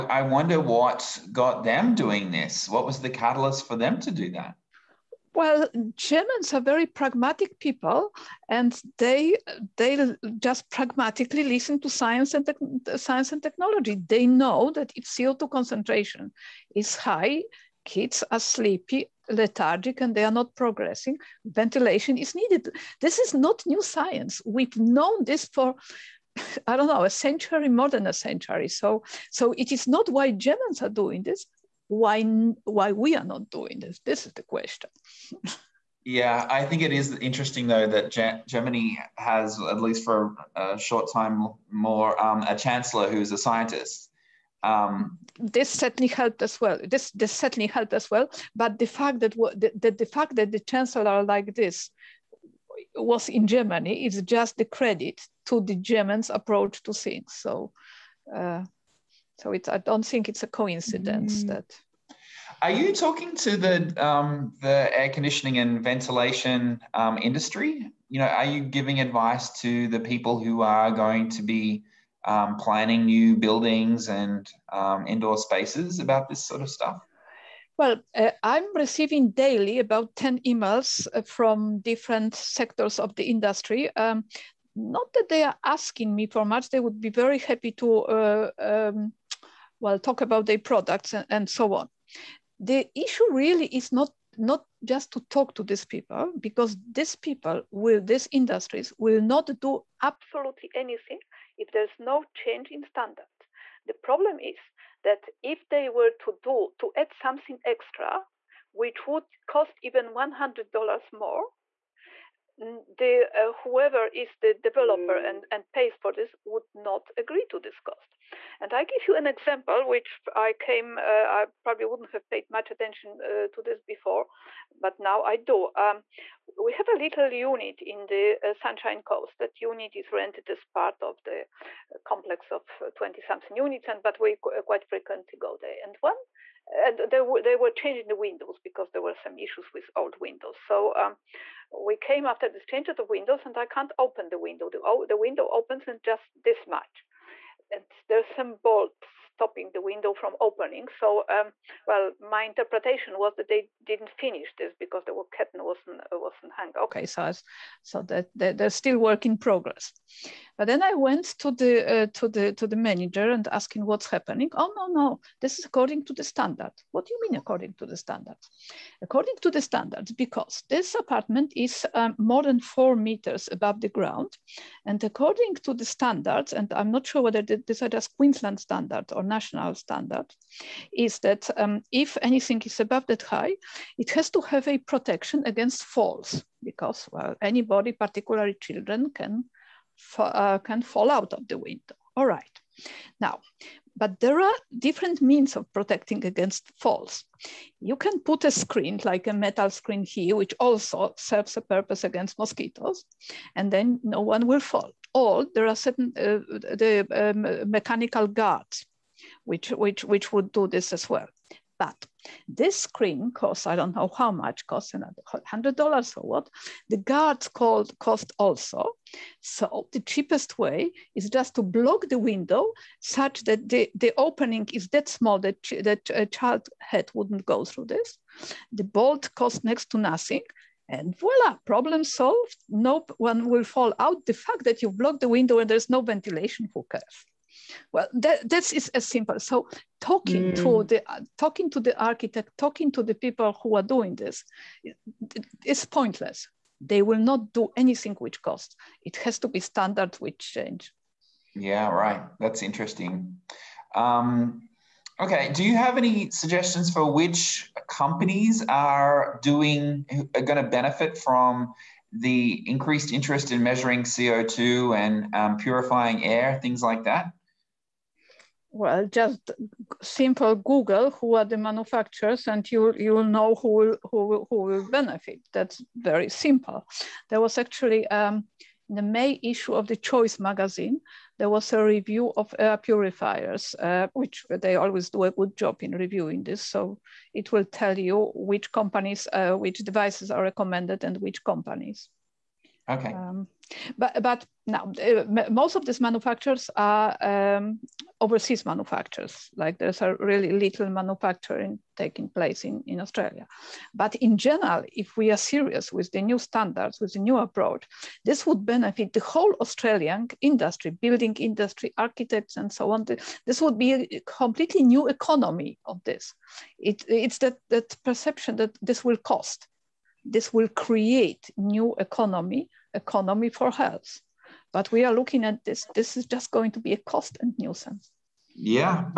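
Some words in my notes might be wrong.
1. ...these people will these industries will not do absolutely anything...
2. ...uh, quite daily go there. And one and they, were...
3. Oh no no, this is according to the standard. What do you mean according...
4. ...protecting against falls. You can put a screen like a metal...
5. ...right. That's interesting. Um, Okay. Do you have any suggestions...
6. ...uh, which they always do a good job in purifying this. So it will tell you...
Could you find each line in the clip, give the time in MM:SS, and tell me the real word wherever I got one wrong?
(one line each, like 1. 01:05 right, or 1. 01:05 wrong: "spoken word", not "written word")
1. 01:36 right
2. 02:14 wrong: "frequently", not "daily"
3. 02:44 right
4. 03:15 right
5. 04:11 right
6. 04:43 wrong: "reviewing", not "purifying".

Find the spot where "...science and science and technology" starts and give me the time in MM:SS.
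00:11.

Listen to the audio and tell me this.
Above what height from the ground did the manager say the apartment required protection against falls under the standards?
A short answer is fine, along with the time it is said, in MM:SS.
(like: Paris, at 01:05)
4 meters, at 02:52.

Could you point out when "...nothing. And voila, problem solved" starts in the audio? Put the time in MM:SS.
03:49.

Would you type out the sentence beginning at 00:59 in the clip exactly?
I don't think it's a coincidence mm.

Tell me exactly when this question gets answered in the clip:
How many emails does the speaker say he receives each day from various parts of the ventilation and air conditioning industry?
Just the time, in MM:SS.
01:20.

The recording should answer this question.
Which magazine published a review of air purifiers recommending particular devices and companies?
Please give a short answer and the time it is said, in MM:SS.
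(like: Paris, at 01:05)
Choice, at 04:39.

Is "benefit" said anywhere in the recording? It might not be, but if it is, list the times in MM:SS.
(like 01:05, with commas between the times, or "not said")
04:20, 04:34, 05:08.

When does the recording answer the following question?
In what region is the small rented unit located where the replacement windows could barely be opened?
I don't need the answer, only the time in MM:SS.
02:08.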